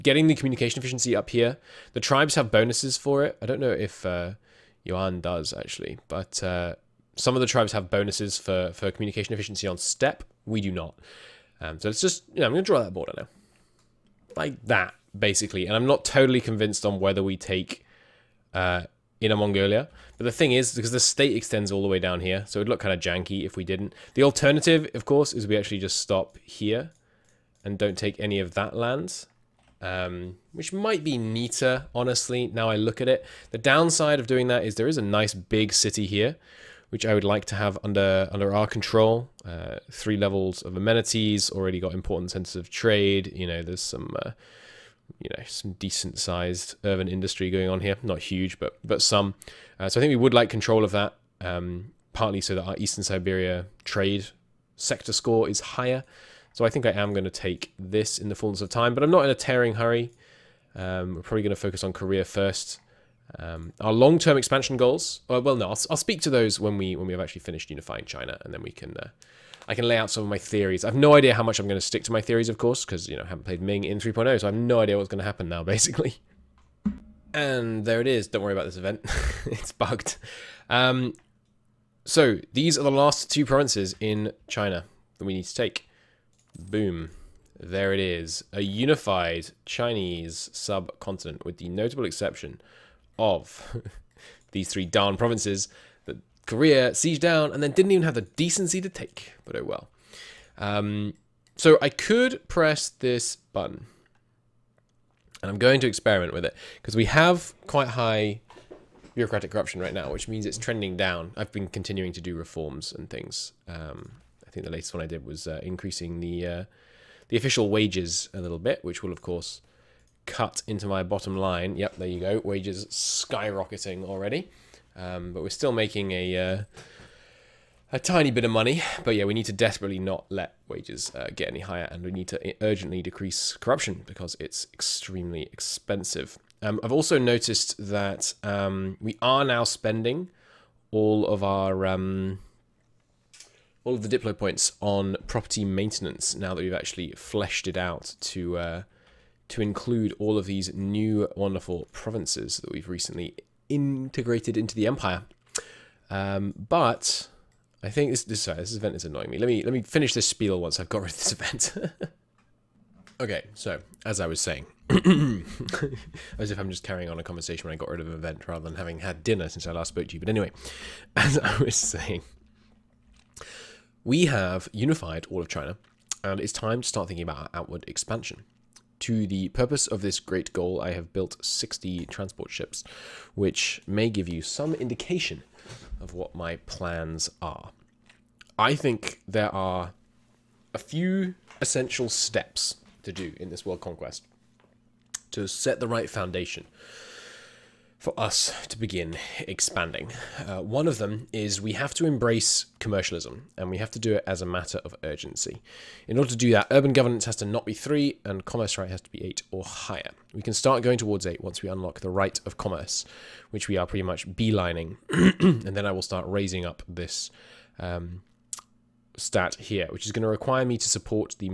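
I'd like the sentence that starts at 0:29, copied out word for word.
Um, which might be neater, honestly, now I look at it.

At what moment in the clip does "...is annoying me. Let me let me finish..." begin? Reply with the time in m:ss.
2:38.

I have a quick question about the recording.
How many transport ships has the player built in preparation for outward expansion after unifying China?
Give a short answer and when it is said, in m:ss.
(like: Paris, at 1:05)
60, at 3:01.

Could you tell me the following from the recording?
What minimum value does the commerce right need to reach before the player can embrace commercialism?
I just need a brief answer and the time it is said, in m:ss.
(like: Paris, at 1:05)
8, at 3:29.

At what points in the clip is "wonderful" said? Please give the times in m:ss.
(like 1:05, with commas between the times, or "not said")
2:31.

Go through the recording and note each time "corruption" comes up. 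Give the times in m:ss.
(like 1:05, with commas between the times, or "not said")
1:49, 2:13.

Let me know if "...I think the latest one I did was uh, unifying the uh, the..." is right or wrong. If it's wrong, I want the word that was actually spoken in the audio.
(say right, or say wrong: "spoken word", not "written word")
wrong: "increasing", not "unifying".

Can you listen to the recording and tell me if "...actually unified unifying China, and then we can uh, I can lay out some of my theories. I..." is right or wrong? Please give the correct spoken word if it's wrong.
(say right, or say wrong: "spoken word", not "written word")
wrong: "finished", not "unified".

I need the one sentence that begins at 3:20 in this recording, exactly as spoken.
Uh, one of them is we have to embrace commercialism and we have to do it as a matter of urgency.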